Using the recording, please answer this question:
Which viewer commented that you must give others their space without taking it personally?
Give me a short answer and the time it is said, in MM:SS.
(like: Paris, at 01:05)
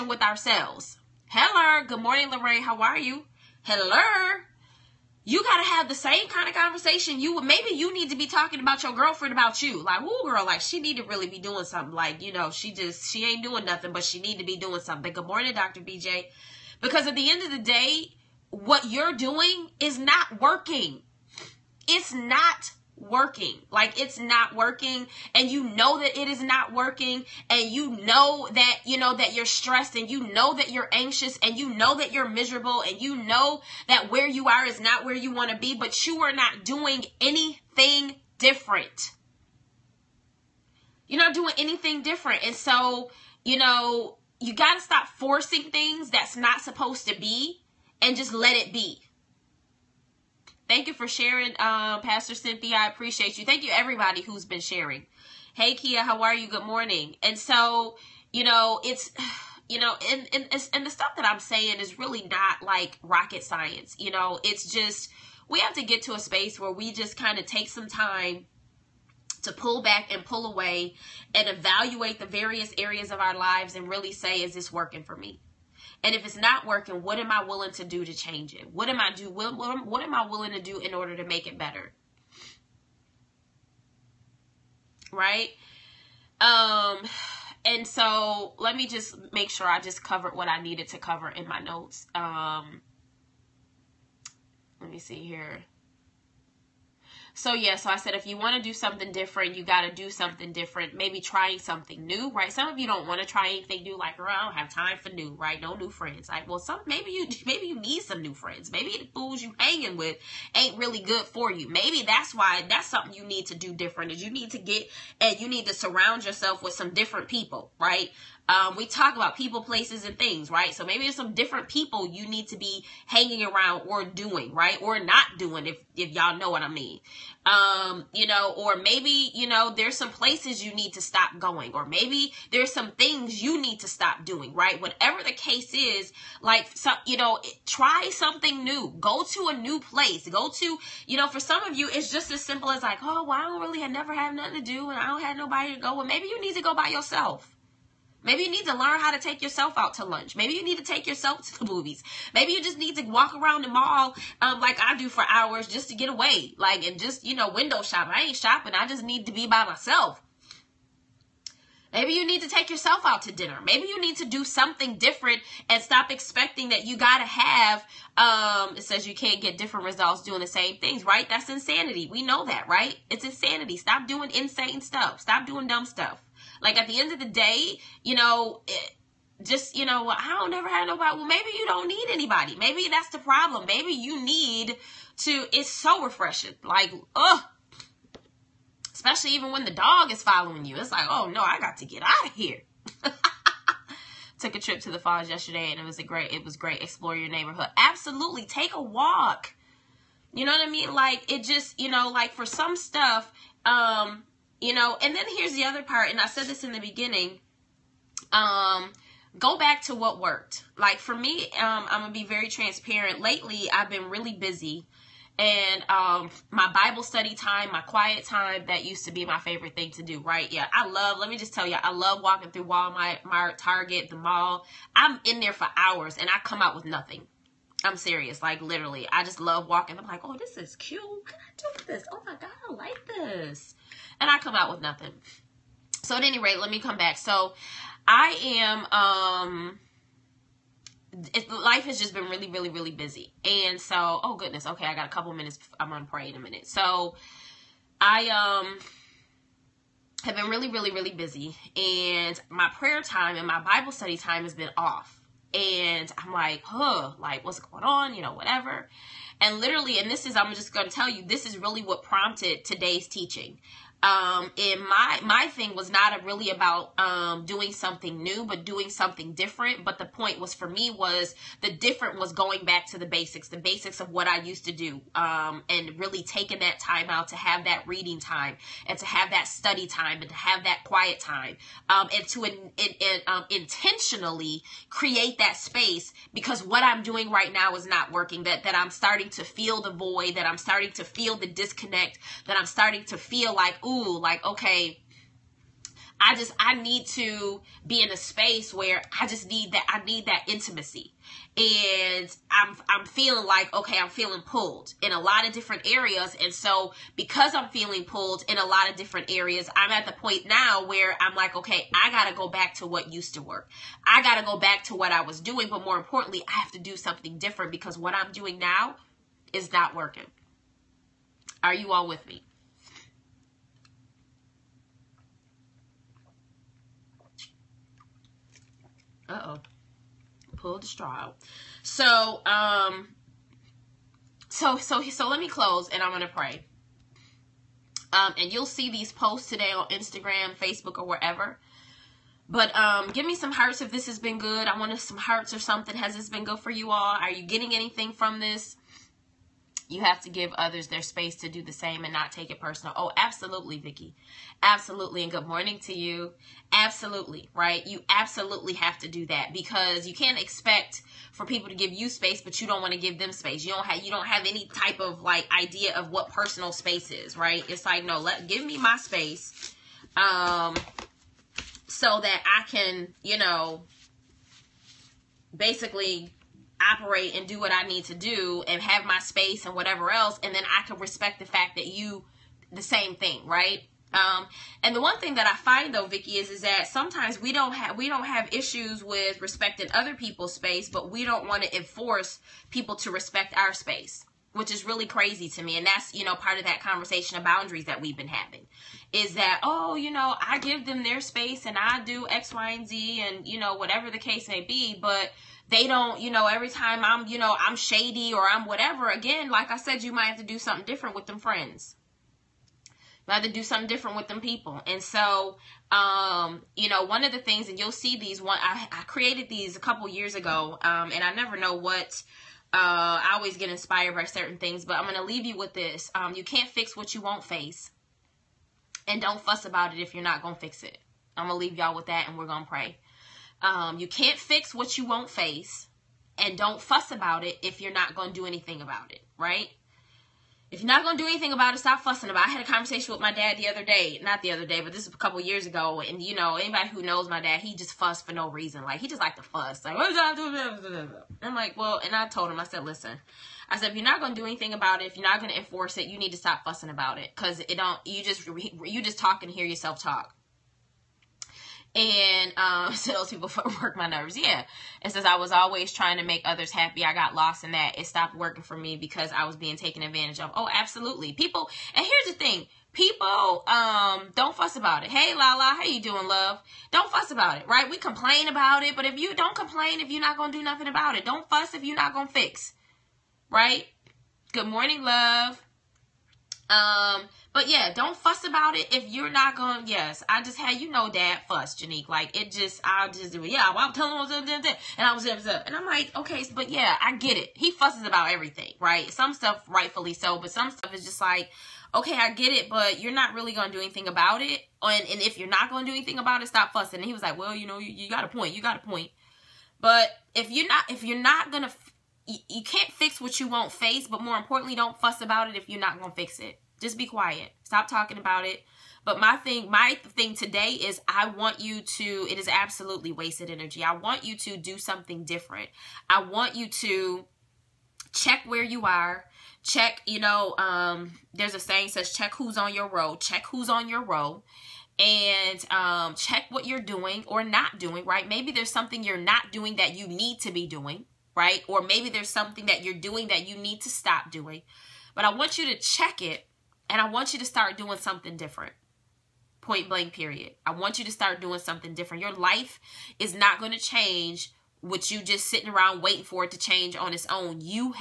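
Vicki, at 05:53.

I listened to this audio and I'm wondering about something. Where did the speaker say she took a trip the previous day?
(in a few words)
The falls.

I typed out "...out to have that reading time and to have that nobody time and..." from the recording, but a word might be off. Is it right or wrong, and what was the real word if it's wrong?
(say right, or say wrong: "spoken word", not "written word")
wrong: "study", not "nobody".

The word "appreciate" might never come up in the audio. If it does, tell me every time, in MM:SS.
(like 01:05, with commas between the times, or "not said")
00:52.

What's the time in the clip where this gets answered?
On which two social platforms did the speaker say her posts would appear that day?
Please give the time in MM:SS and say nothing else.
05:39.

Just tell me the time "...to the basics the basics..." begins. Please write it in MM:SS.
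04:32.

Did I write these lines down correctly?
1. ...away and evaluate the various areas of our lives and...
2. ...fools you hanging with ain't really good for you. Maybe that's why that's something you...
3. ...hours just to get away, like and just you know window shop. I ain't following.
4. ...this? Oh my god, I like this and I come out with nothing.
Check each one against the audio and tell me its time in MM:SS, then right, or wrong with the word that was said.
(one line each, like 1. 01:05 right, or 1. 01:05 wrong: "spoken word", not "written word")
1. 01:10 right
2. 01:49 right
3. 02:35 wrong: "shopping", not "following"
4. 03:51 right.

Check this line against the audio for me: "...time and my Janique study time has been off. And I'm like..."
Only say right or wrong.
wrong.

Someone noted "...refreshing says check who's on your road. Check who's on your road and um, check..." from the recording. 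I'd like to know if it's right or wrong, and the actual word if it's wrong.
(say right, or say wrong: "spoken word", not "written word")
wrong: "saying", not "refreshing".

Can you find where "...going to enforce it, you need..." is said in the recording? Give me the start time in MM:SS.
07:35.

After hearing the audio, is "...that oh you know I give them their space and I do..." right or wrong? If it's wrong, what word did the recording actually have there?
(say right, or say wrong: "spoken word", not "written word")
right.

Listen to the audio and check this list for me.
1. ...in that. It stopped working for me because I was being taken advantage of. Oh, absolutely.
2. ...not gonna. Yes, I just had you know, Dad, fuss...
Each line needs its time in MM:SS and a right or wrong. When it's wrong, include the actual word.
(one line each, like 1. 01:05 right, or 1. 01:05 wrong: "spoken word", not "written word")
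1. 07:47 right
2. 08:09 right.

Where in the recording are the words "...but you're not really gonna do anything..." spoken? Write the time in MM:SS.
08:22.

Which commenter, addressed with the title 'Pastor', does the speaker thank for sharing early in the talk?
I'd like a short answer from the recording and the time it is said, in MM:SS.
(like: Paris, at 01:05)
Pastor Cynthia, at 00:51.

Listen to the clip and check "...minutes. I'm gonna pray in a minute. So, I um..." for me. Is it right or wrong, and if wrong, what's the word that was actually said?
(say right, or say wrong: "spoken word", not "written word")
right.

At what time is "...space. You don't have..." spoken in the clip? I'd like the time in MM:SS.
06:03.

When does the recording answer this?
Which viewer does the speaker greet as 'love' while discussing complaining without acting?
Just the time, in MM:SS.
07:55.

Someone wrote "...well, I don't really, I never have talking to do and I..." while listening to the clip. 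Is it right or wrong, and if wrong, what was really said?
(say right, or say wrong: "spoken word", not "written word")
wrong: "nothing", not "talking".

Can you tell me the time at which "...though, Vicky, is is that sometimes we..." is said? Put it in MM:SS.
06:25.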